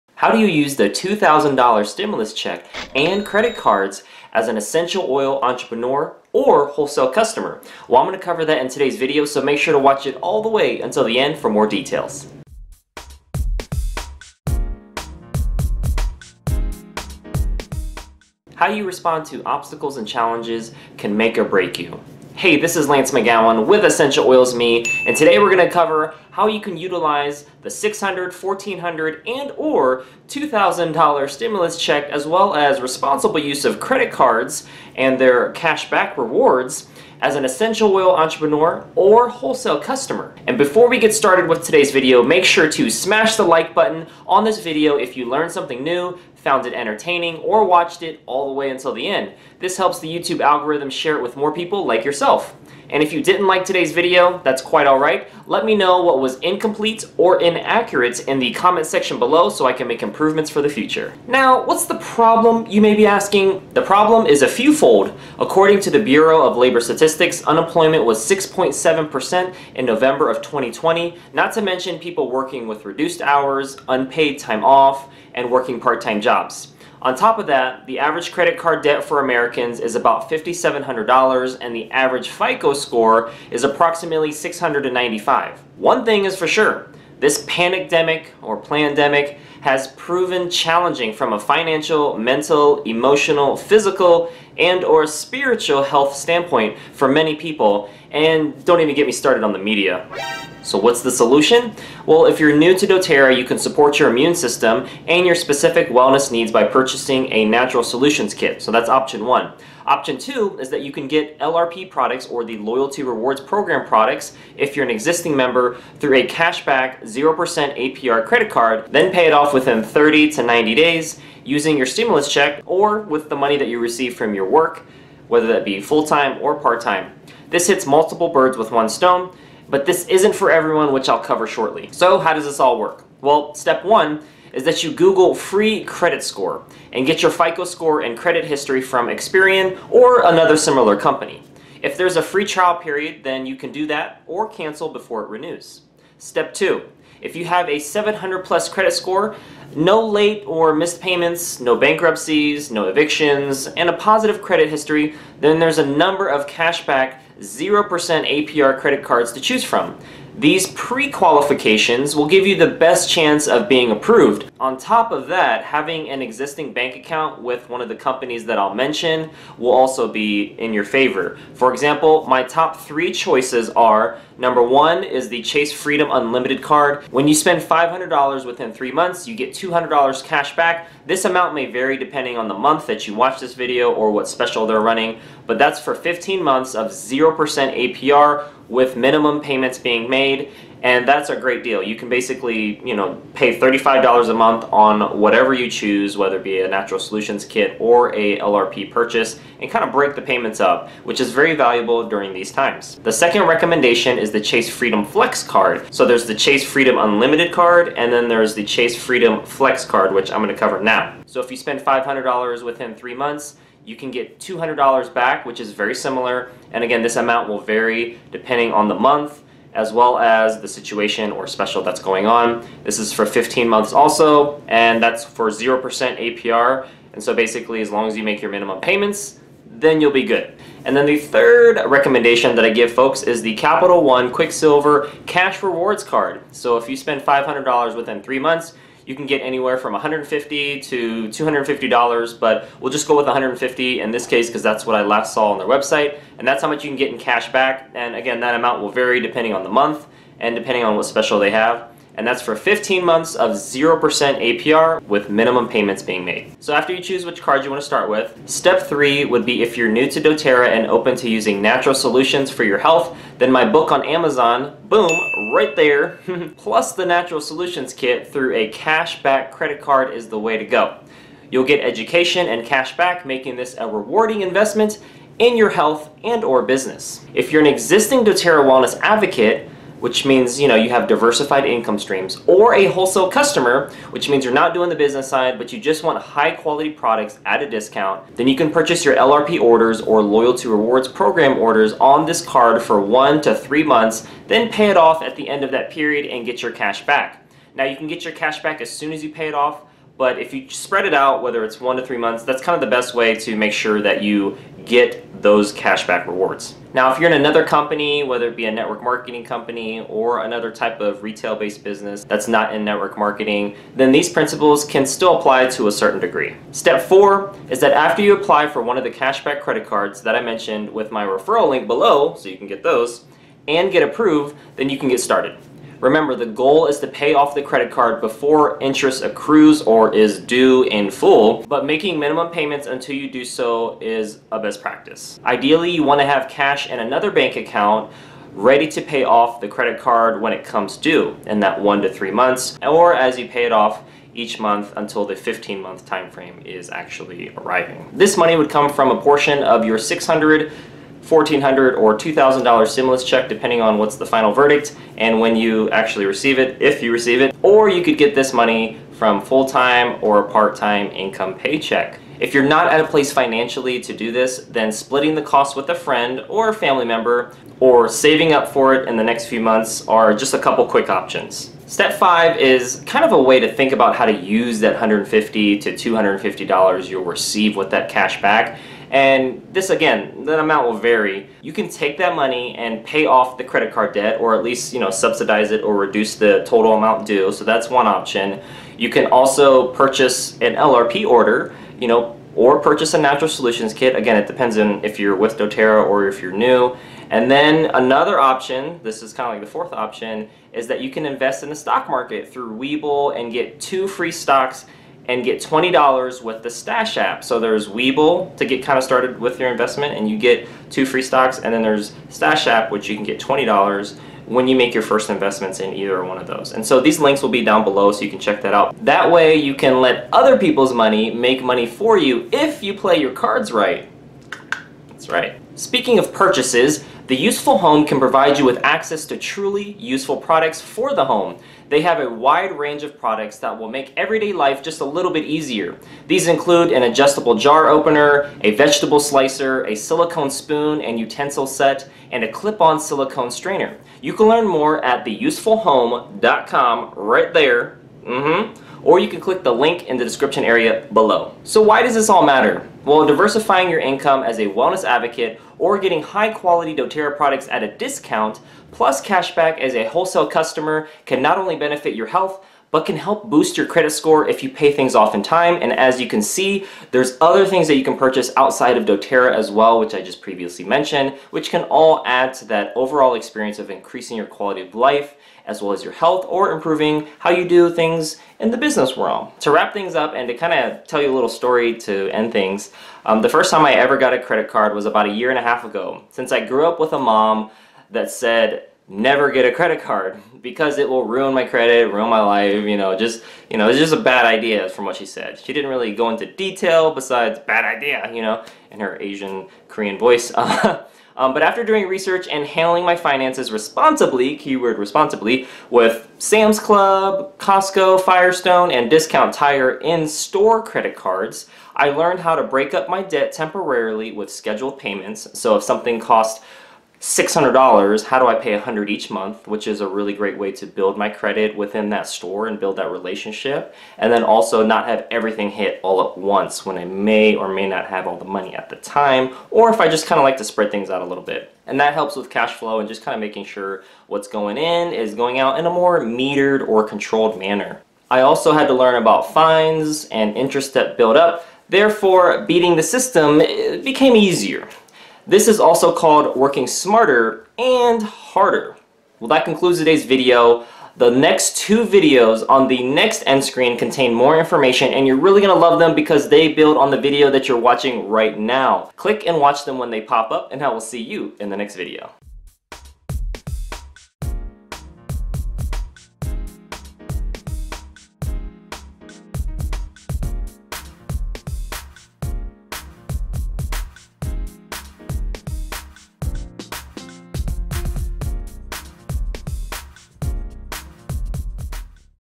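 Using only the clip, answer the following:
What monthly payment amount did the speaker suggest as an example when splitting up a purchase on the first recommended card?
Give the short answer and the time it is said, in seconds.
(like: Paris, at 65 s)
$35, at 193 s.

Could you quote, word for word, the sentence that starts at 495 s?
She didn't really go into detail besides bad idea, you know, in her Asian Korean voice.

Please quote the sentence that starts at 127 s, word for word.
This hits multiple birds with one stone but this isn't for everyone, which I'll cover shortly.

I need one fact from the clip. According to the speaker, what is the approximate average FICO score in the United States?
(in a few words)
695.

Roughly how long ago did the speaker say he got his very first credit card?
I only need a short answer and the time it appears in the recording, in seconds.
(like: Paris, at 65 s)
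A year and a half, at 485 s.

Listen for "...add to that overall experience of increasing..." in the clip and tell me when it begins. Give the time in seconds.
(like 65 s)
472 s.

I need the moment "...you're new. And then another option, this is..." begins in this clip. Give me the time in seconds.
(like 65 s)
396 s.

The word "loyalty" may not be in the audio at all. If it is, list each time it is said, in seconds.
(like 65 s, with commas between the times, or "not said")
112 s, 290 s.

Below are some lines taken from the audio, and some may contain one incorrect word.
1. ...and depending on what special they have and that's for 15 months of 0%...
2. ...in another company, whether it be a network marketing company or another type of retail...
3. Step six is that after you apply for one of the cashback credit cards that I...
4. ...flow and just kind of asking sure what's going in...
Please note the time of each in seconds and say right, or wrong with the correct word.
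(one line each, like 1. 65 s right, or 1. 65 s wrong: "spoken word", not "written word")
1. 250 s right
2. 307 s right
3. 316 s wrong: "four", not "six"
4. 532 s wrong: "making", not "asking".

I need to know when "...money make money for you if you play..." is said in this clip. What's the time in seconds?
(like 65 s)
420 s.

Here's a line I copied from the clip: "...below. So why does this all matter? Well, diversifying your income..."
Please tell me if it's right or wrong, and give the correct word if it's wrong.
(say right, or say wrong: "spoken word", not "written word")
right.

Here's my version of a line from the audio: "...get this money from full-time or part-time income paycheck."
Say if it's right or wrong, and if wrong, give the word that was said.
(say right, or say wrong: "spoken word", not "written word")
right.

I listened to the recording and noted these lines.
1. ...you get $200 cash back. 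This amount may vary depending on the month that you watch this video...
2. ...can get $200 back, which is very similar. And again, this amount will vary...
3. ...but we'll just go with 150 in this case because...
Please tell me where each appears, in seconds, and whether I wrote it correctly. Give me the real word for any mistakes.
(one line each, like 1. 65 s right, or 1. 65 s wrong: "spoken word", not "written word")
1. 179 s right
2. 213 s right
3. 242 s right.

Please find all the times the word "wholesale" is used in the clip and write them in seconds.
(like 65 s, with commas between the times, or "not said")
6 s, 39 s, 282 s, 460 s.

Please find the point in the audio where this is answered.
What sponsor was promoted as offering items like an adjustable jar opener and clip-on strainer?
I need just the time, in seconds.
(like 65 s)
427 s.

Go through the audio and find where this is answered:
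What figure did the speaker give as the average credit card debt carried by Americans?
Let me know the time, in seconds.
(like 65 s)
80 s.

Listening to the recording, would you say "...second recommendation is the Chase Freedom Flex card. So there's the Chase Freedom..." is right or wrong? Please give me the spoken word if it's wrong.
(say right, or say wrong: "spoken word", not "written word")
right.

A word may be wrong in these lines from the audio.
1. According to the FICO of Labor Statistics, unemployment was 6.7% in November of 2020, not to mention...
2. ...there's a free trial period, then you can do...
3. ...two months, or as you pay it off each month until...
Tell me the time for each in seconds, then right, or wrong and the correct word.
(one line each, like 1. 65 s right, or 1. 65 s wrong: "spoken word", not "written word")
1. 65 s wrong: "Bureau", not "FICO"
2. 141 s right
3. 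342 s wrong: "three", not "two".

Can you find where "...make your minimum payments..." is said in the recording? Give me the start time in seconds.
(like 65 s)
228 s.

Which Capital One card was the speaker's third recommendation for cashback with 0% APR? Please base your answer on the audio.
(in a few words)
Quicksilver Cash Rewards Card.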